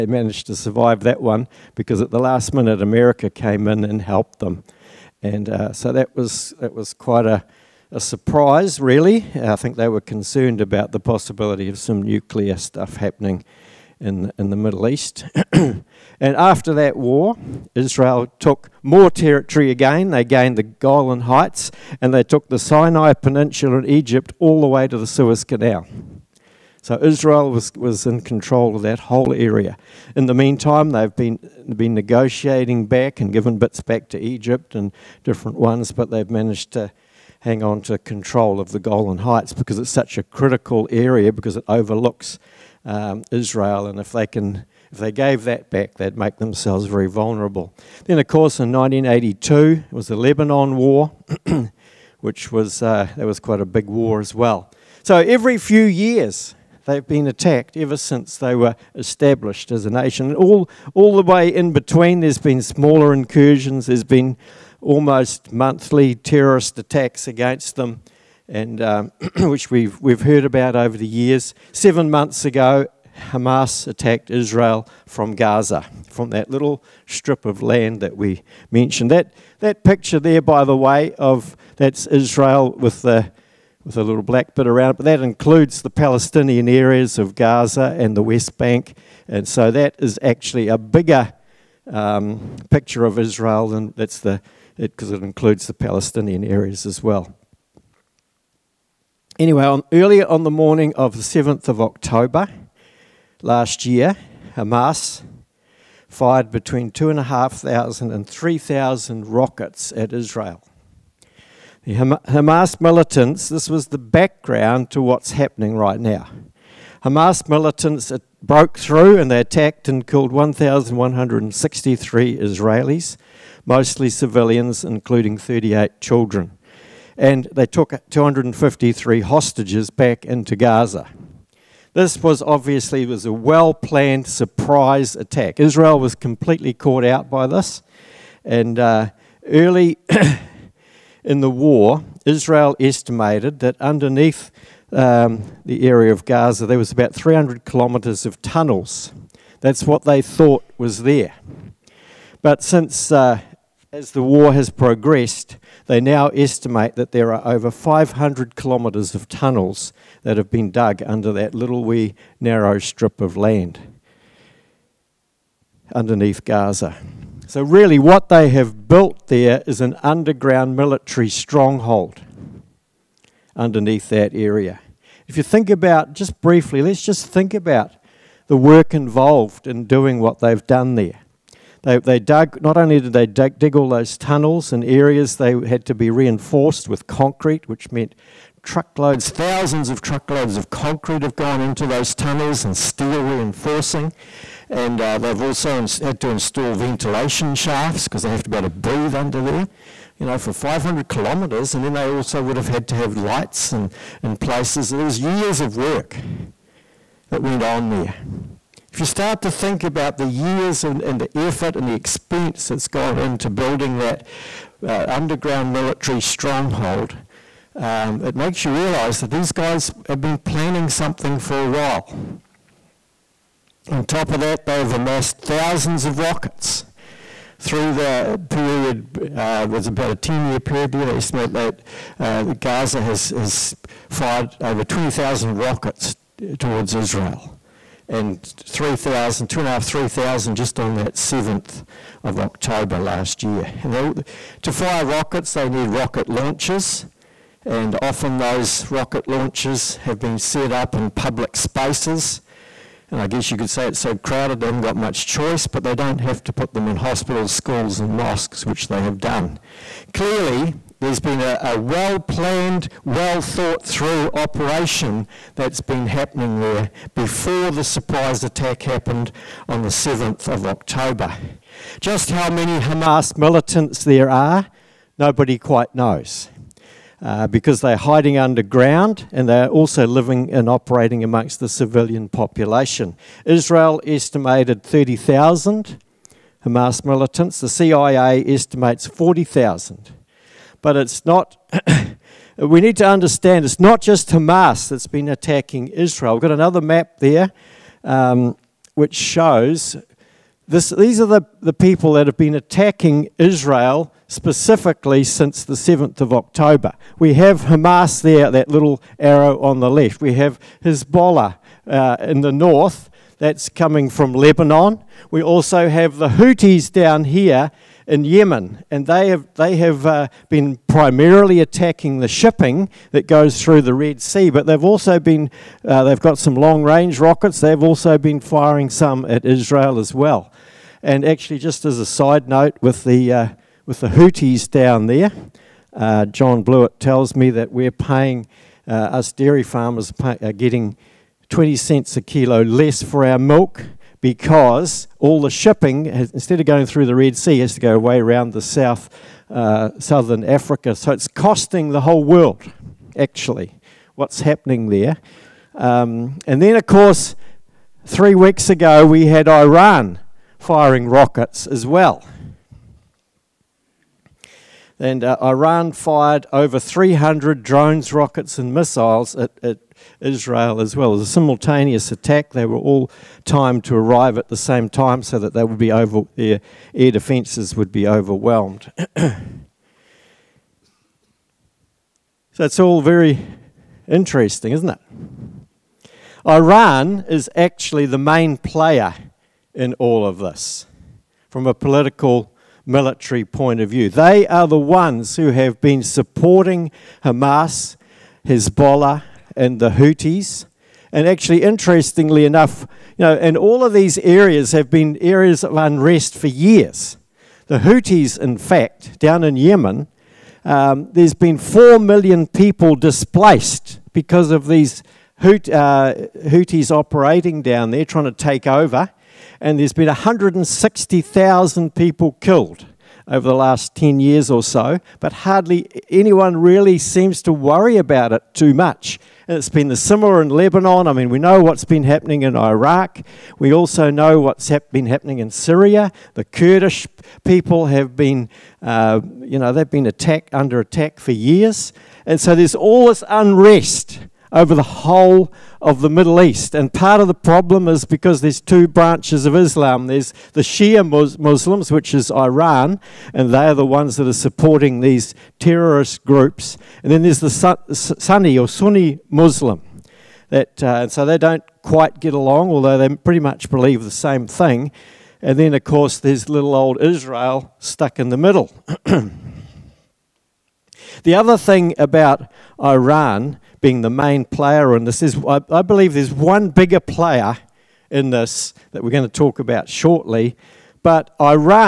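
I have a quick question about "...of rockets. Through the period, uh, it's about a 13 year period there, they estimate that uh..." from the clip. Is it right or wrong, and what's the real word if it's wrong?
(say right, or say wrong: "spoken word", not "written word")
wrong: "10", not "13".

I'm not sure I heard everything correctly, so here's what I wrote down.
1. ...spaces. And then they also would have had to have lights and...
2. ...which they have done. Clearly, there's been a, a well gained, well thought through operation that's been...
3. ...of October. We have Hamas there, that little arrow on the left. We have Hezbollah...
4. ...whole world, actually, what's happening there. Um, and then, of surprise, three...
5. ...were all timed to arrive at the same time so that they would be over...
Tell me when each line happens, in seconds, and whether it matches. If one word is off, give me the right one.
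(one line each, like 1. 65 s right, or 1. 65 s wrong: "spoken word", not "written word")
1. 201 s wrong: "kilometres", not "spaces"
2. 258 s wrong: "planned", not "gained"
3. 306 s right
4. 352 s wrong: "course", not "surprise"
5. 372 s right.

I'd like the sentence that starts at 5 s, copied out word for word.
And uh, so that was, that was quite a, a surprise, really.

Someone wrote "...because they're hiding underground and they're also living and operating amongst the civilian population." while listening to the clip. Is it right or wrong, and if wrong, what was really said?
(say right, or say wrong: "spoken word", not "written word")
right.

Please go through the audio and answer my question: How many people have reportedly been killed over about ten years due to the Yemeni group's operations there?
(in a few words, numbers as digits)
160,000.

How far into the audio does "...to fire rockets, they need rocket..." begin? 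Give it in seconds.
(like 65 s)
244 s.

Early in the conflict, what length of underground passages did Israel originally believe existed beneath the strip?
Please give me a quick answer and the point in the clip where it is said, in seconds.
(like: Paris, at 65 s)
300 kilometres, at 147 s.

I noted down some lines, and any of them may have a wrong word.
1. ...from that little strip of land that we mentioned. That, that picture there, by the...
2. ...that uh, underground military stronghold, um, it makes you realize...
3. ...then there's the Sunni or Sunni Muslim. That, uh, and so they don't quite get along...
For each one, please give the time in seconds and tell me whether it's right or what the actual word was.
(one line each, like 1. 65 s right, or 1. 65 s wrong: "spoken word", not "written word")
1. 76 s right
2. 213 s right
3. 457 s right.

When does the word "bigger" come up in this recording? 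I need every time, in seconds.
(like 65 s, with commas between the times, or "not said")
90 s, 476 s.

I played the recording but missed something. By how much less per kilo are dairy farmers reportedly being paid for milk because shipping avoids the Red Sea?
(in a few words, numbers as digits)
20 cents.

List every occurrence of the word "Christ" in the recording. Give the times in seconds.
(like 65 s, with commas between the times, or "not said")
not said.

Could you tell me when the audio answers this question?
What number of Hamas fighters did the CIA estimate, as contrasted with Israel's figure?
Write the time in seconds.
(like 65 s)
289 s.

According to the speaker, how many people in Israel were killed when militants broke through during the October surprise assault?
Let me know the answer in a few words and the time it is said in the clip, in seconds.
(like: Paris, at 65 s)
1,163, at 120 s.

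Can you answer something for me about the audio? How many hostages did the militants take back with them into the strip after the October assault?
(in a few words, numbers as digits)
253.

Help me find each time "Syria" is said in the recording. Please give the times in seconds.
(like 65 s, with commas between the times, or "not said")
435 s.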